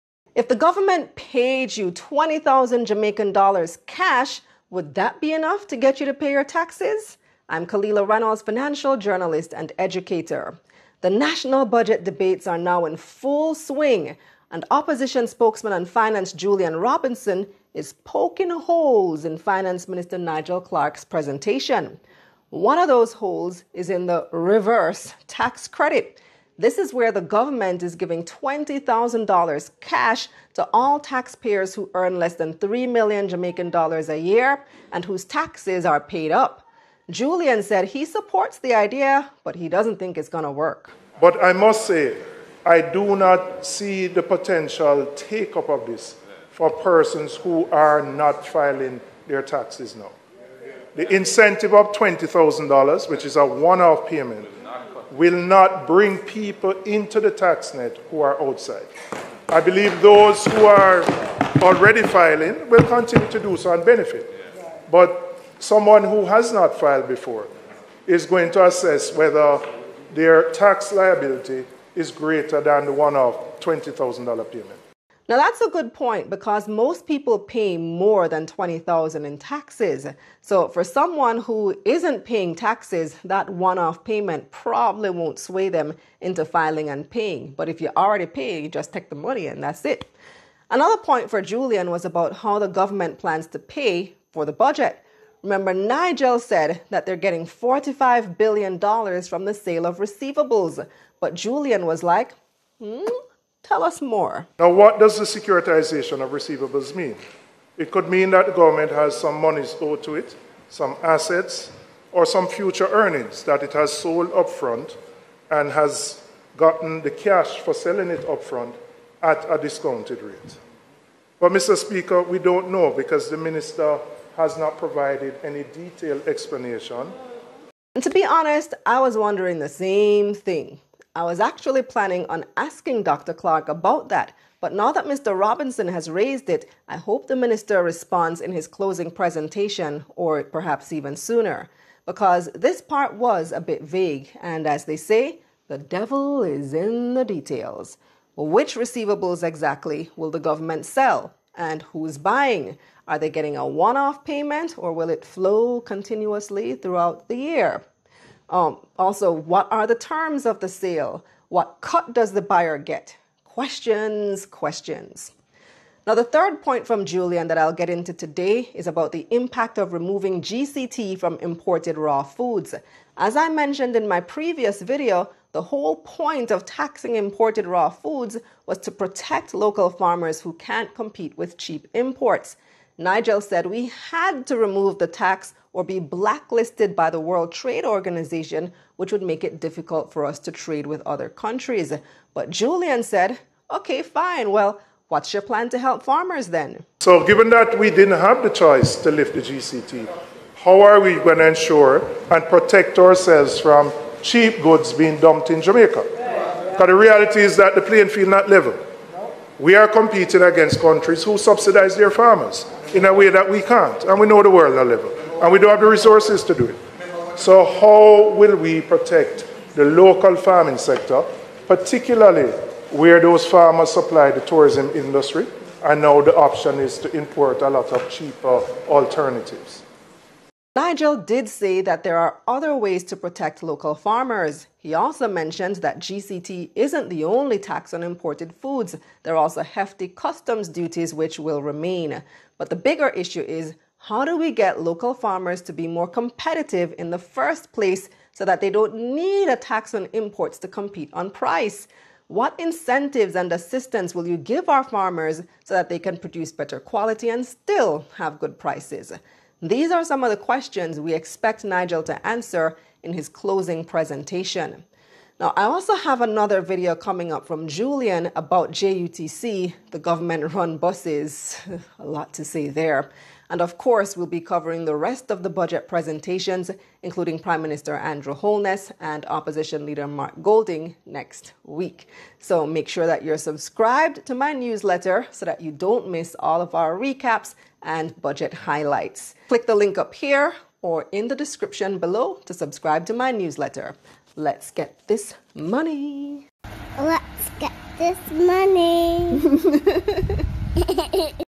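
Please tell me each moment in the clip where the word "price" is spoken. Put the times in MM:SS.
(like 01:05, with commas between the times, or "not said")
04:11, 04:18.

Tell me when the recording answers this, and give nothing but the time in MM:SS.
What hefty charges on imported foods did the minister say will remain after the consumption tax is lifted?
04:00.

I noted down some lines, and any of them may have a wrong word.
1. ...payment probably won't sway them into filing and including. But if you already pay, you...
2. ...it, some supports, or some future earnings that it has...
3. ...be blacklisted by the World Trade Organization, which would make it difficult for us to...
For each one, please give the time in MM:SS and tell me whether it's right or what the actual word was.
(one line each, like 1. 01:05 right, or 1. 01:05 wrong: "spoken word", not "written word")
1. 01:24 wrong: "paying", not "including"
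2. 01:50 wrong: "assets", not "supports"
3. 03:05 right.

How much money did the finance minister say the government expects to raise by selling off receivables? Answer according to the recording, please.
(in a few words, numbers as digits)
$45 billion.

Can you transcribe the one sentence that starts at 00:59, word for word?
I believe those who are already filing will continue to do so and benefit.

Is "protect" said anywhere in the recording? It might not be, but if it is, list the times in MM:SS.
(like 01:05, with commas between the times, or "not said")
02:58, 03:22, 03:38, 03:53.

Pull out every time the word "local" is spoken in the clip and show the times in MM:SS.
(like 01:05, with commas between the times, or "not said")
02:59, 03:39, 03:53, 04:04.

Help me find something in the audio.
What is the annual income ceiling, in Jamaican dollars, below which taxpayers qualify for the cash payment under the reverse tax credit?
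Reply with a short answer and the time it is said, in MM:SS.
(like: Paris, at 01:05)
3 million, at 00:32.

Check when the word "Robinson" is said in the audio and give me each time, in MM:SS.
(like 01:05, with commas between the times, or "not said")
00:16, 02:15.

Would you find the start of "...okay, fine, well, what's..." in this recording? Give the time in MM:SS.
03:13.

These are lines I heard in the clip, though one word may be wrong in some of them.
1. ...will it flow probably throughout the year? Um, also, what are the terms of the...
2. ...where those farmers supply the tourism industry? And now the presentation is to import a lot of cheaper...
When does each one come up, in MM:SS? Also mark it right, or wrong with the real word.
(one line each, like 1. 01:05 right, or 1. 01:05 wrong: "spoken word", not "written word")
1. 02:34 wrong: "continuously", not "probably"
2. 03:42 wrong: "option", not "presentation".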